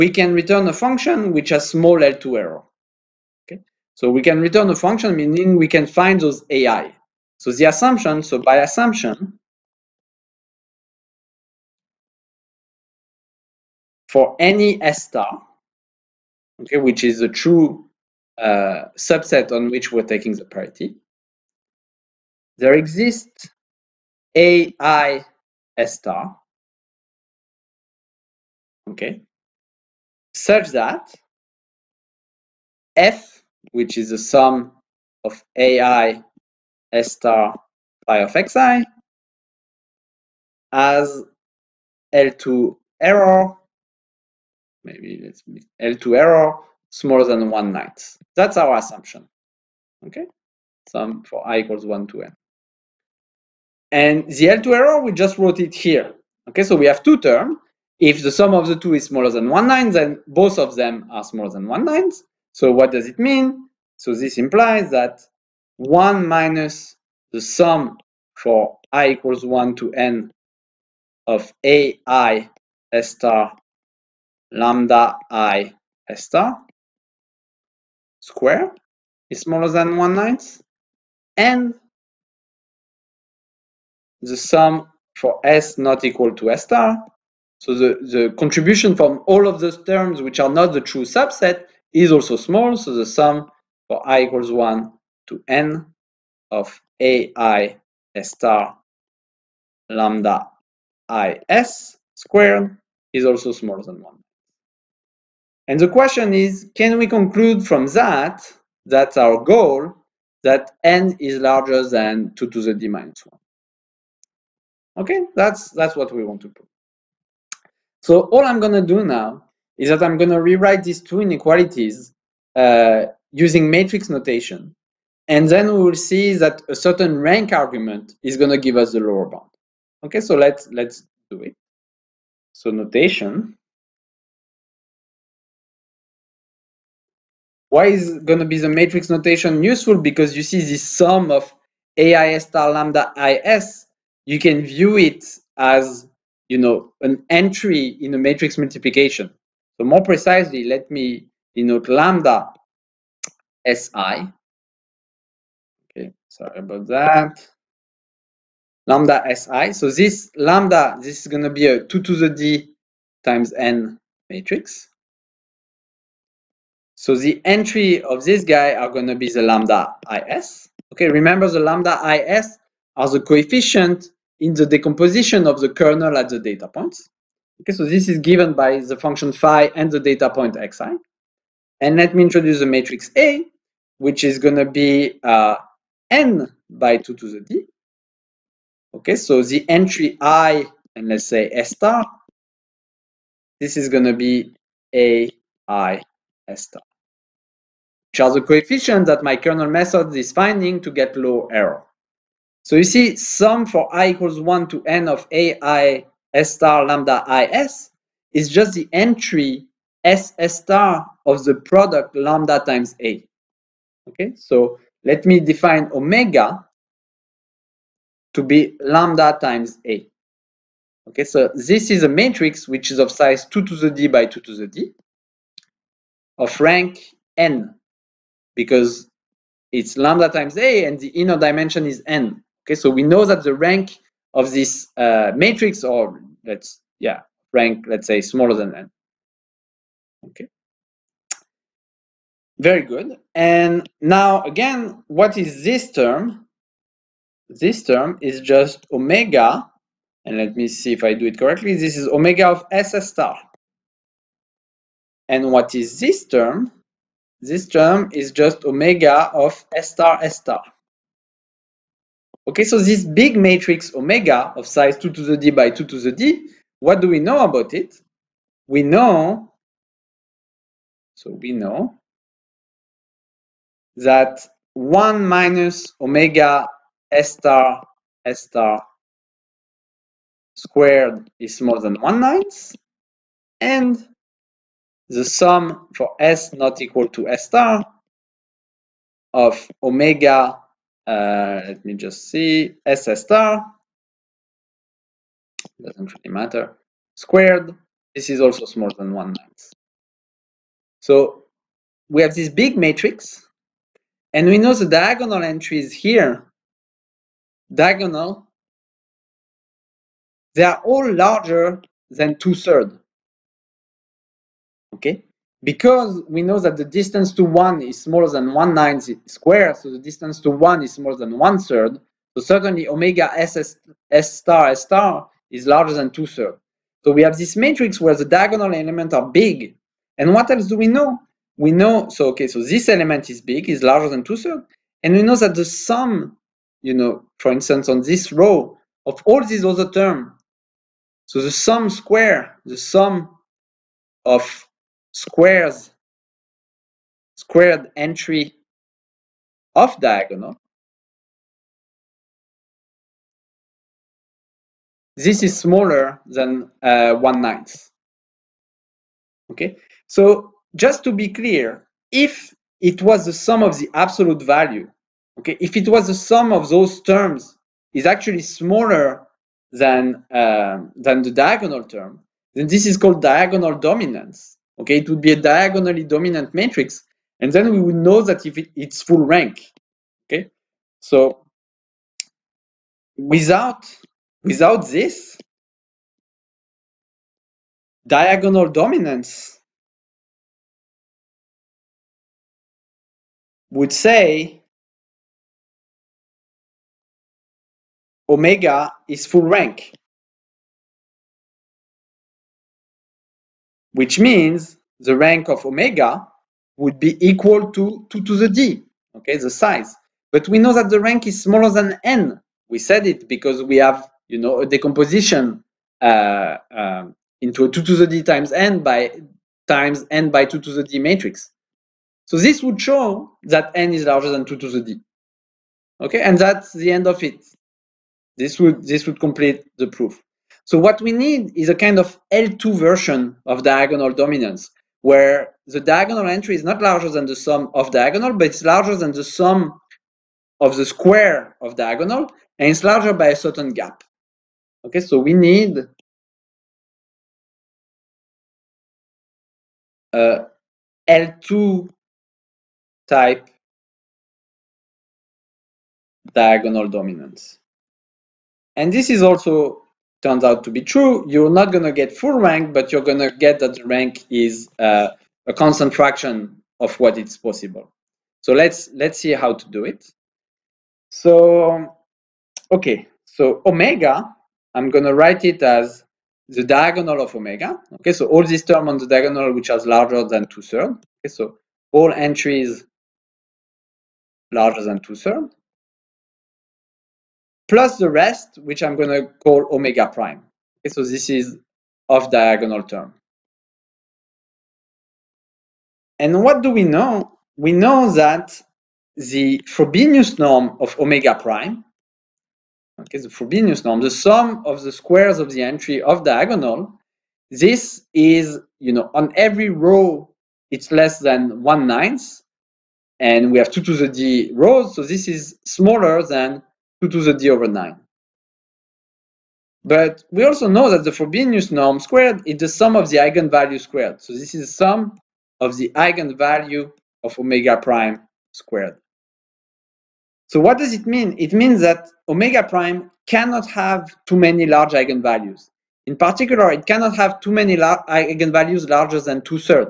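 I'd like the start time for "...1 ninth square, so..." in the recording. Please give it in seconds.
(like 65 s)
318 s.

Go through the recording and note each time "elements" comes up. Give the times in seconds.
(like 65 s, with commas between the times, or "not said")
328 s, 332 s.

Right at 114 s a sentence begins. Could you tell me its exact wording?
Okay, that's, that's what we want to prove.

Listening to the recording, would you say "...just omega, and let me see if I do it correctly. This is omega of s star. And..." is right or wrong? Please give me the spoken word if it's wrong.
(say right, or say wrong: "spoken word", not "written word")
right.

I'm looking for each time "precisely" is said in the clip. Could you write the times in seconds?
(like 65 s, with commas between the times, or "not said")
150 s.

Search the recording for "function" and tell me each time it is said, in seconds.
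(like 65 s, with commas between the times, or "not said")
0 s, 4 s, 178 s.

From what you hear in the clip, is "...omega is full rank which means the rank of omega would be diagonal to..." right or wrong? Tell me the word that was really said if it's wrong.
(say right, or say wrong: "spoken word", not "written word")
wrong: "equal", not "diagonal".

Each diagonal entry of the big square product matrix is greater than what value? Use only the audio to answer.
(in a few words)
2/3.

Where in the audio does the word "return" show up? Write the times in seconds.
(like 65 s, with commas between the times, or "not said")
0 s, 4 s.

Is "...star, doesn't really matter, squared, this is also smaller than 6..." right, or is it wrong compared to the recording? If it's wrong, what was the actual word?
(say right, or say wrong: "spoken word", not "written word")
wrong: "1", not "6".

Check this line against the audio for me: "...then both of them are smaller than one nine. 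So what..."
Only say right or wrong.
right.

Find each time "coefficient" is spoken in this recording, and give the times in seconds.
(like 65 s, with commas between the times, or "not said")
173 s, 198 s.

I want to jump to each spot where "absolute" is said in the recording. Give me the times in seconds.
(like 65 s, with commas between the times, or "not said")
363 s.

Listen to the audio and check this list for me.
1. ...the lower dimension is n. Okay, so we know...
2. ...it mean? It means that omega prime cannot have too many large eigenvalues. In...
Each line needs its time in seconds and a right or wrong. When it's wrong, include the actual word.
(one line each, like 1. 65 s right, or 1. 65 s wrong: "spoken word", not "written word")
1. 230 s wrong: "inner", not "lower"
2. 530 s right.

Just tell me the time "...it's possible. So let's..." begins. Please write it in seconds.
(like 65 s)
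467 s.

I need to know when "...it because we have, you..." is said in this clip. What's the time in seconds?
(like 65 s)
413 s.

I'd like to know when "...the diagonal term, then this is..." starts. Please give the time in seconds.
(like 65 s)
371 s.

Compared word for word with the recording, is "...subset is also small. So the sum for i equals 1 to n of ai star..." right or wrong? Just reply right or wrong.
right.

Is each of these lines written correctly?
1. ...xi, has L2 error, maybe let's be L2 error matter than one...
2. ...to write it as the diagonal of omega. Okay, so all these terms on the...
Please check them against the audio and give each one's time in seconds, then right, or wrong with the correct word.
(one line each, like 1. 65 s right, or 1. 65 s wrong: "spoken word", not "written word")
1. 38 s wrong: "smaller", not "matter"
2. 475 s right.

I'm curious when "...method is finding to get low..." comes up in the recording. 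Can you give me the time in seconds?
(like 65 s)
199 s.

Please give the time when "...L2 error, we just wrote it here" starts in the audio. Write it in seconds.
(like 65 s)
54 s.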